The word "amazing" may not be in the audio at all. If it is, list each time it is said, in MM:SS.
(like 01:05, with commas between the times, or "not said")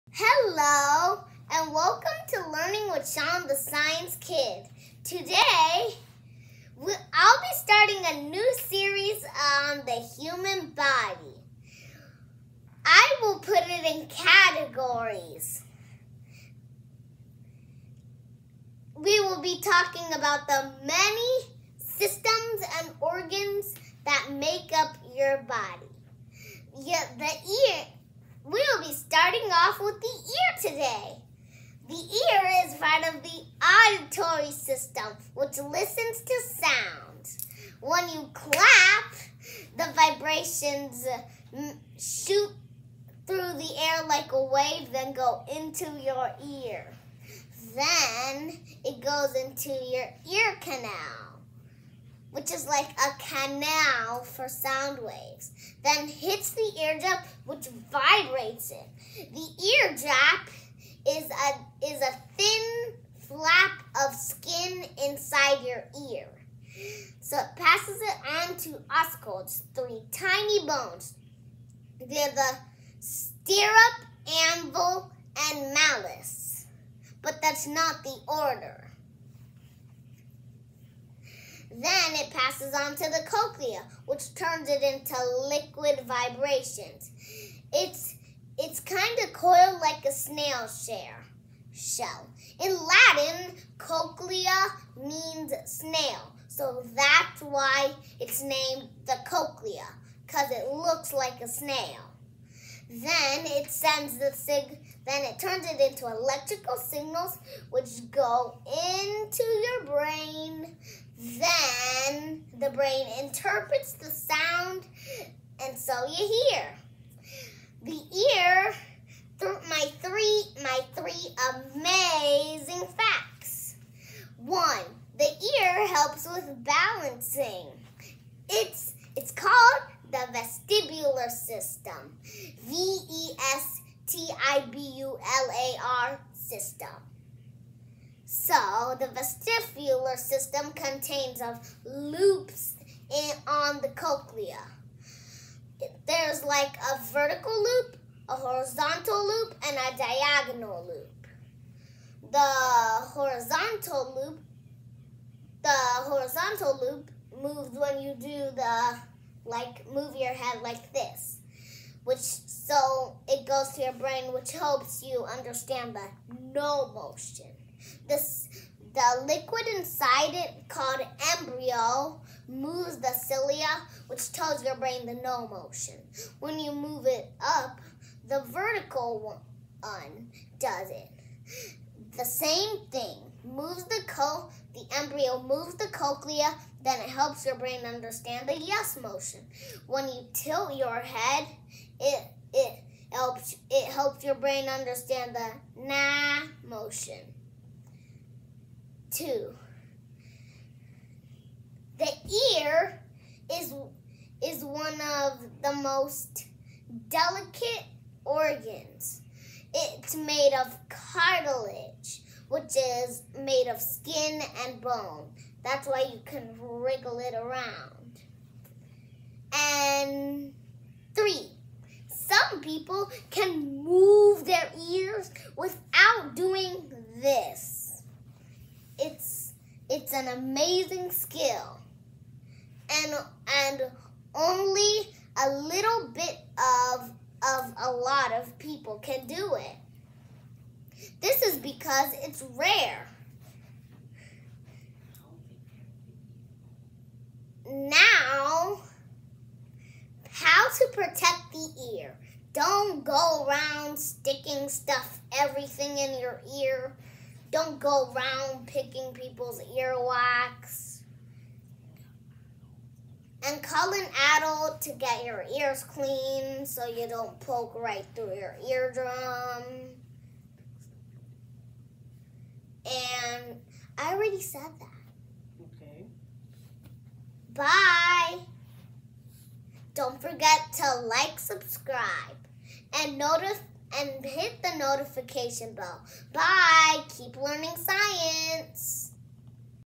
02:01, 03:50.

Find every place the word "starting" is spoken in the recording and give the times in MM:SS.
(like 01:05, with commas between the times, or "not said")
00:07, 00:29.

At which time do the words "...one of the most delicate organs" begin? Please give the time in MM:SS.
03:24.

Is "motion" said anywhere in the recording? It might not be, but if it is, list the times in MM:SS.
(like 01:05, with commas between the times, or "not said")
02:46, 02:55, 03:09, 03:16.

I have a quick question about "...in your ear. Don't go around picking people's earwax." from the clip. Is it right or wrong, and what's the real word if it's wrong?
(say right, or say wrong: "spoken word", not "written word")
right.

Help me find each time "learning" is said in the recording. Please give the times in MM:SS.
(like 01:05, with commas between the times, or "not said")
00:02, 04:47.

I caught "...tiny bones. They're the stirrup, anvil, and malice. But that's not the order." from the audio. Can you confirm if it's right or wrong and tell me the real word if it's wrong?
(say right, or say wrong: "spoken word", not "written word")
right.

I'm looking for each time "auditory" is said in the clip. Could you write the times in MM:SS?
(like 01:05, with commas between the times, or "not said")
00:33.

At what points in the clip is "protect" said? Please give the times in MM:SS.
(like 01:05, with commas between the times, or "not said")
04:10.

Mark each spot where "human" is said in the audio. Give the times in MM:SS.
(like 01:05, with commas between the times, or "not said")
00:10.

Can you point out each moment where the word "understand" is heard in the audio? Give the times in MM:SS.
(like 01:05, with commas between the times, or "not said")
02:45, 03:07, 03:14.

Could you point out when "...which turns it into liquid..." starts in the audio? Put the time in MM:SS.
01:24.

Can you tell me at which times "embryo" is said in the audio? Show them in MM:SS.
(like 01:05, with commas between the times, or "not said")
02:51, 03:04.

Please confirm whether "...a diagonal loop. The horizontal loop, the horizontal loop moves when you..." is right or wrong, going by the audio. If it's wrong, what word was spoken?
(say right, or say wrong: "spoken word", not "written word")
right.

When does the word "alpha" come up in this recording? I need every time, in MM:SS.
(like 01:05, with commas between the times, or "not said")
not said.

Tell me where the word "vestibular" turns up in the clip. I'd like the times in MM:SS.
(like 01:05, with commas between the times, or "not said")
02:10, 02:19.